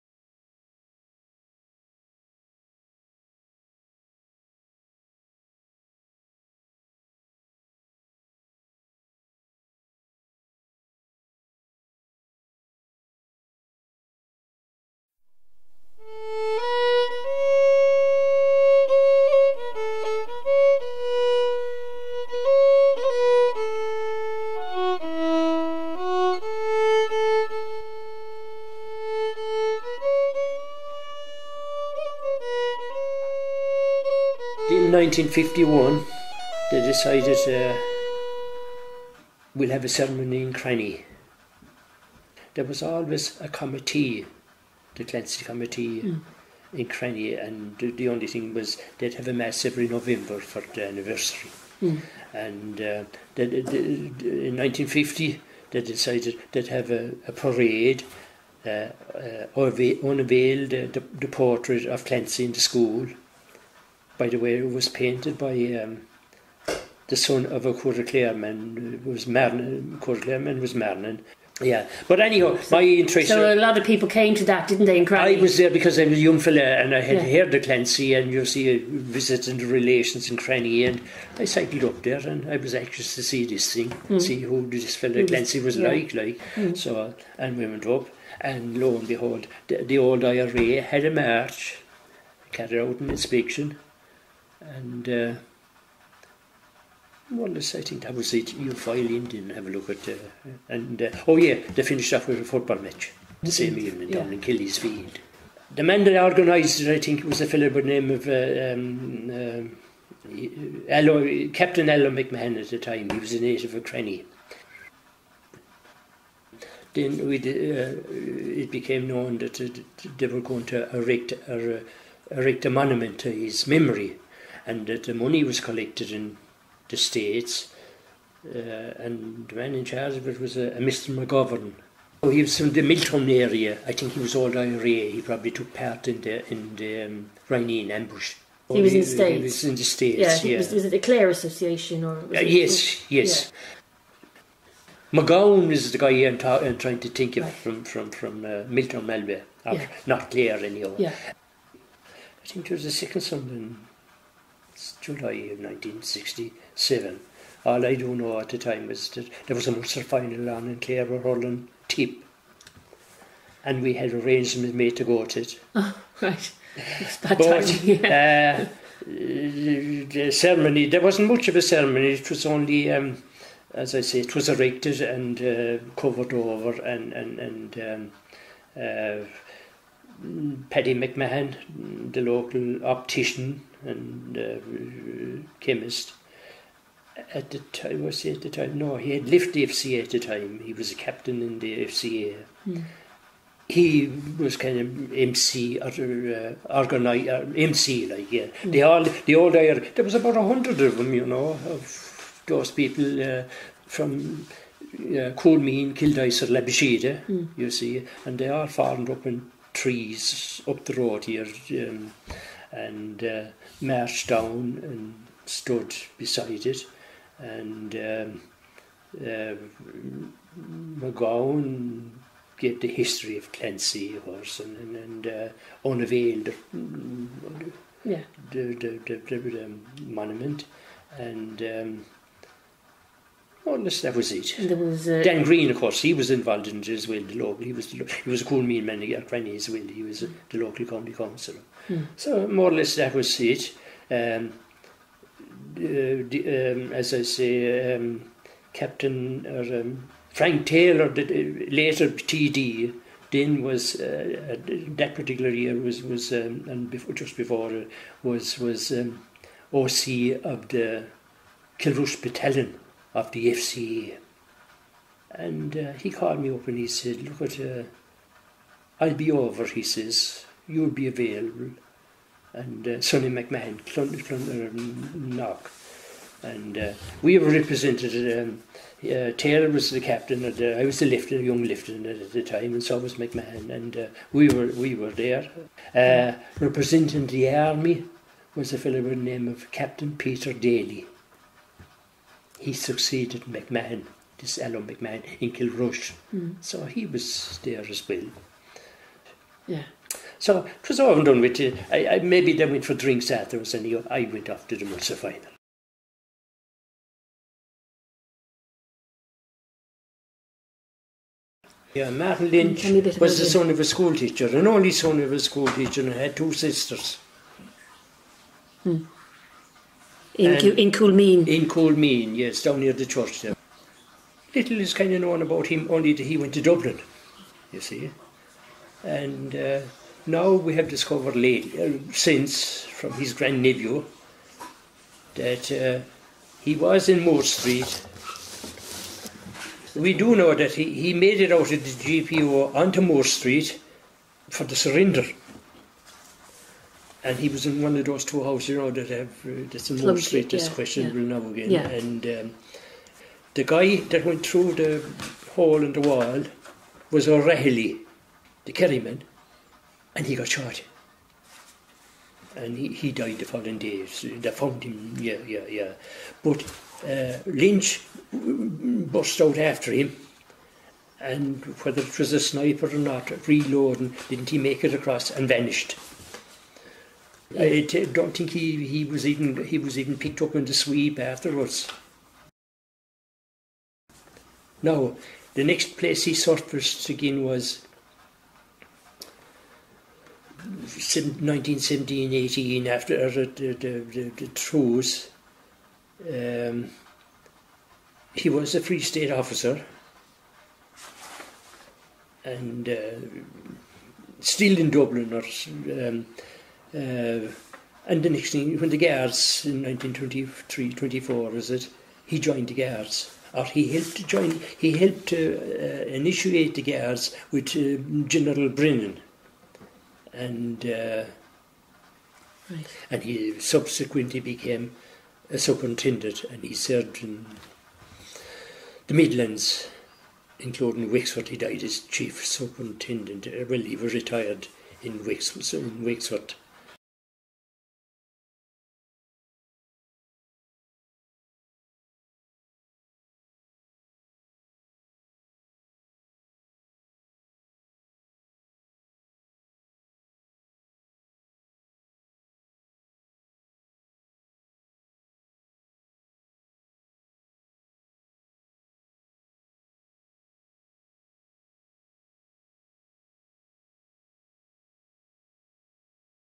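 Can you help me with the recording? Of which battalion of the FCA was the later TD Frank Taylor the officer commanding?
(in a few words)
Kilrush Battalion.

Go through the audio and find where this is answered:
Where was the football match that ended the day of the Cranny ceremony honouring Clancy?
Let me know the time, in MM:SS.
01:44.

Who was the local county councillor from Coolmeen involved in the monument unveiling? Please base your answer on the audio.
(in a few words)
Dan Green.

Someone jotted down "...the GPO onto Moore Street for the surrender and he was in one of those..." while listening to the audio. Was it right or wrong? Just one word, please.
right.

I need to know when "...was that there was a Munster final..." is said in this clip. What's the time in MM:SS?
02:38.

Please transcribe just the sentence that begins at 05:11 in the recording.
Yeah, Martin Lynch was the son of a schoolteacher, an only son of a schoolteacher, and had two sisters.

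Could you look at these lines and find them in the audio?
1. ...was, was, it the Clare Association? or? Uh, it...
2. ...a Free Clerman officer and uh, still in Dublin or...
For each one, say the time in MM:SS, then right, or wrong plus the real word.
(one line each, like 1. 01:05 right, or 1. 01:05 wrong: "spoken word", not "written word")
1. 02:20 right
2. 06:38 wrong: "State", not "Clerman".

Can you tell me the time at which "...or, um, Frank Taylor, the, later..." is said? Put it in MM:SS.
04:09.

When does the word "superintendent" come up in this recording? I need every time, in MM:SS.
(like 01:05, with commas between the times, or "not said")
07:05, 07:12.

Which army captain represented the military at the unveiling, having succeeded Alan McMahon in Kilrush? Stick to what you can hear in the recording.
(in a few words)
Peter Daly.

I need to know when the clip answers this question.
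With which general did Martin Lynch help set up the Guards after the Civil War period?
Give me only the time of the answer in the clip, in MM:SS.
06:58.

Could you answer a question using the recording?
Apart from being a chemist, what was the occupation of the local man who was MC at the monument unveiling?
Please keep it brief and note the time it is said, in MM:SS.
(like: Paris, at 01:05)
optician, at 03:02.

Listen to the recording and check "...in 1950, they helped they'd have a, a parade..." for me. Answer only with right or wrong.
wrong.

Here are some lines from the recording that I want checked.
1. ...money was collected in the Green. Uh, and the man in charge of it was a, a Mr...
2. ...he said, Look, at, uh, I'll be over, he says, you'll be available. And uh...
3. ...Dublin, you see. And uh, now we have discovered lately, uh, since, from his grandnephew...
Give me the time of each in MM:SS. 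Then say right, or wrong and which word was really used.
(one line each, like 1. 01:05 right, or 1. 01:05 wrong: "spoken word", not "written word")
1. 02:05 wrong: "States", not "Green"
2. 04:26 right
3. 05:26 right.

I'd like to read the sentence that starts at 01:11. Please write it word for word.
Yeah, but anyhow, so, my interest.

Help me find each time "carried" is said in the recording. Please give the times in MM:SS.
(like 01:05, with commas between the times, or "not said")
01:32.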